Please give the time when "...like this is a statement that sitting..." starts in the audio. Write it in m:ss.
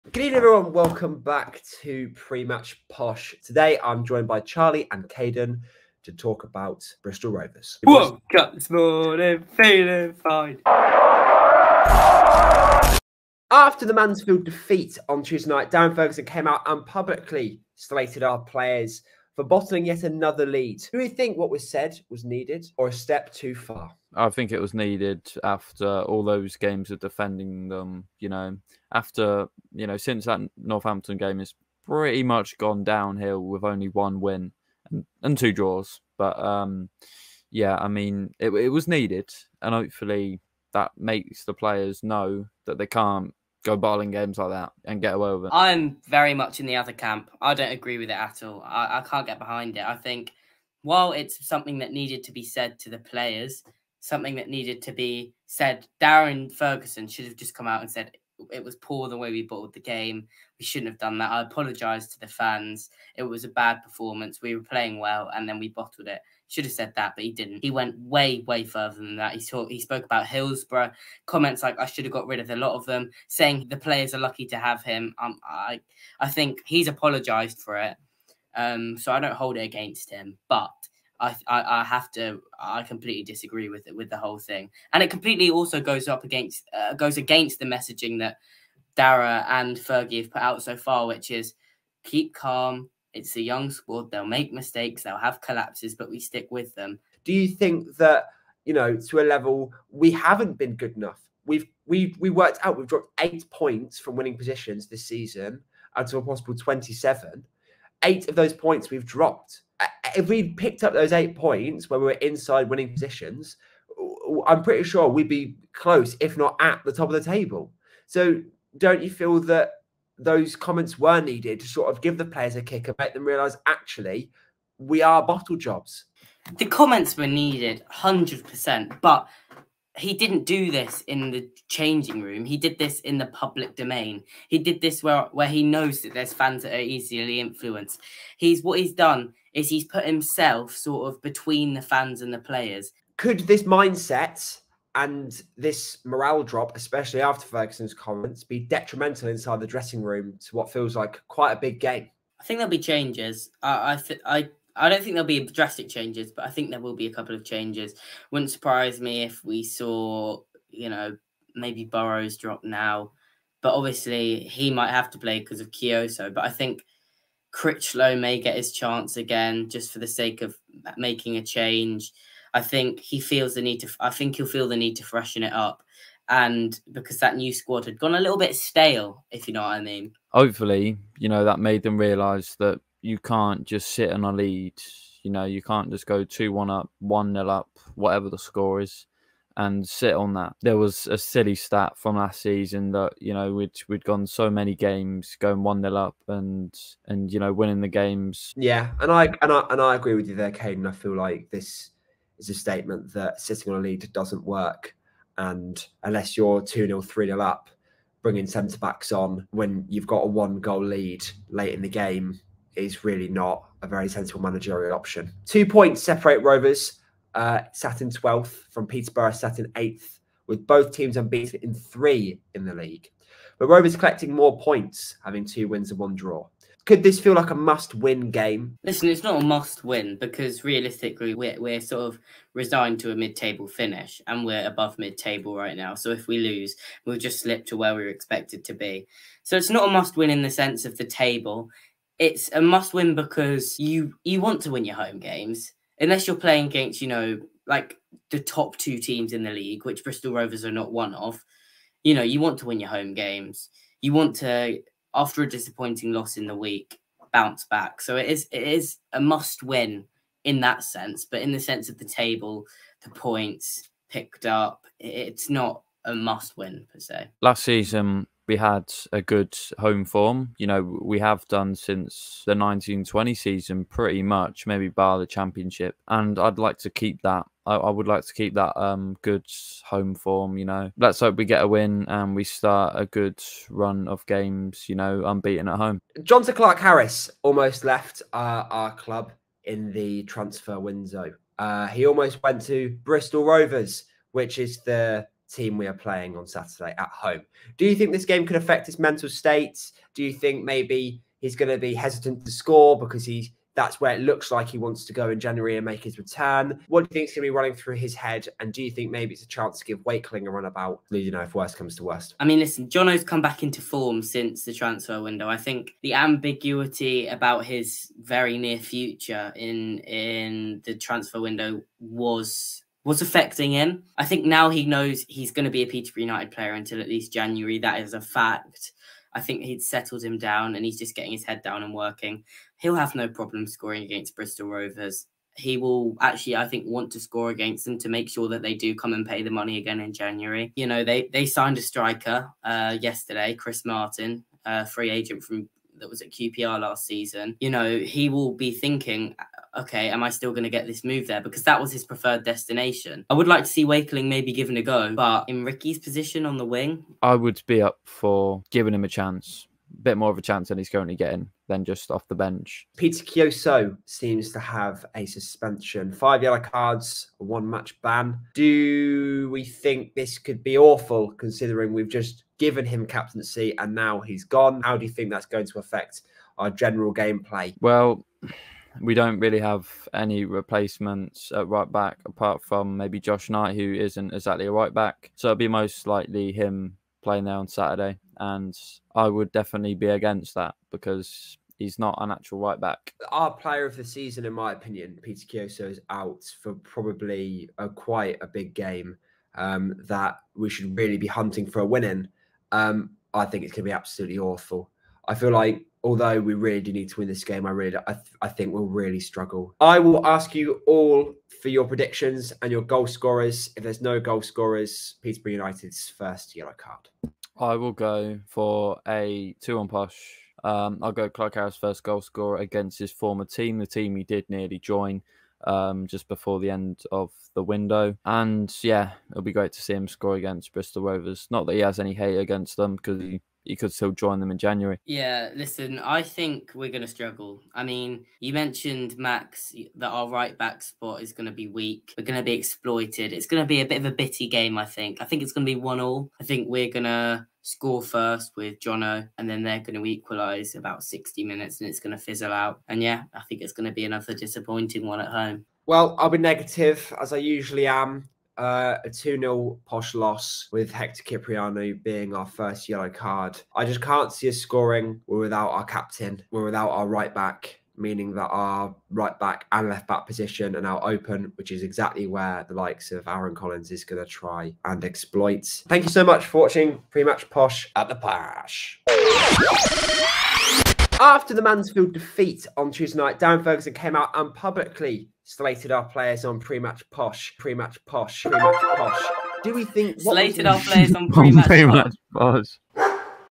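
3:21.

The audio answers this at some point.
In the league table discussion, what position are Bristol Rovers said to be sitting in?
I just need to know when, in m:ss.
3:38.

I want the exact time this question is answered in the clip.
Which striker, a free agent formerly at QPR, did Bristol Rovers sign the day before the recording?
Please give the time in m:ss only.
5:43.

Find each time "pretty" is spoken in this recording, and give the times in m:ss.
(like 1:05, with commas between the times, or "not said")
0:31, 1:54, 4:33.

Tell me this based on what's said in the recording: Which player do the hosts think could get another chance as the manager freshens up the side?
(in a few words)
Critchlow.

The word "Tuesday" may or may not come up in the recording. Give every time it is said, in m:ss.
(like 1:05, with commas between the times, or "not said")
0:15, 8:02.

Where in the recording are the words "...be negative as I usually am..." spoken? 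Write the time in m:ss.
7:36.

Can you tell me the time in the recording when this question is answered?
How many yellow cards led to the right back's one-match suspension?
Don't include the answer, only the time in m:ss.
6:06.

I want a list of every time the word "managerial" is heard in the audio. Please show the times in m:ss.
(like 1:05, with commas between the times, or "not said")
3:34.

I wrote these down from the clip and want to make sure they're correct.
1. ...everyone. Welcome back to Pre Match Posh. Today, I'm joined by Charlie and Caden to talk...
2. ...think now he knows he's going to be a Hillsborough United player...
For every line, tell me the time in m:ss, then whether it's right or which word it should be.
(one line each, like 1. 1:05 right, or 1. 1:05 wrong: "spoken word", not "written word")
1. 0:00 right
2. 5:24 wrong: "Peterborough", not "Hillsborough".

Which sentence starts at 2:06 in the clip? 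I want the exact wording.
The comments were needed, hundred percent.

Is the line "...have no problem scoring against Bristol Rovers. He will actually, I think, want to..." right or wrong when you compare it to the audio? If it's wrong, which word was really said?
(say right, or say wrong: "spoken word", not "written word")
right.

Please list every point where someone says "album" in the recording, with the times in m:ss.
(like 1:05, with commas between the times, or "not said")
not said.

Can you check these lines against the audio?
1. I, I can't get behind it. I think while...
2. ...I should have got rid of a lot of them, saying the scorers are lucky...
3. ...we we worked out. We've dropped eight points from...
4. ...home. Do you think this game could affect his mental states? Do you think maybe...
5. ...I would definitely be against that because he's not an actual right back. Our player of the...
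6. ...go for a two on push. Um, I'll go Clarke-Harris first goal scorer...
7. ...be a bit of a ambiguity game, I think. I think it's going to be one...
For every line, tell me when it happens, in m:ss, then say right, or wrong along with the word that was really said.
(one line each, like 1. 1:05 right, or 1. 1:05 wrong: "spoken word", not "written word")
1. 0:48 right
2. 1:11 wrong: "players", not "scorers"
3. 1:41 right
4. 4:57 right
5. 6:29 right
6. 6:57 right
7. 7:23 wrong: "bitty", not "ambiguity".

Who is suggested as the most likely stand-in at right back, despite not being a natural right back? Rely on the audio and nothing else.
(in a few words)
Josh Knight.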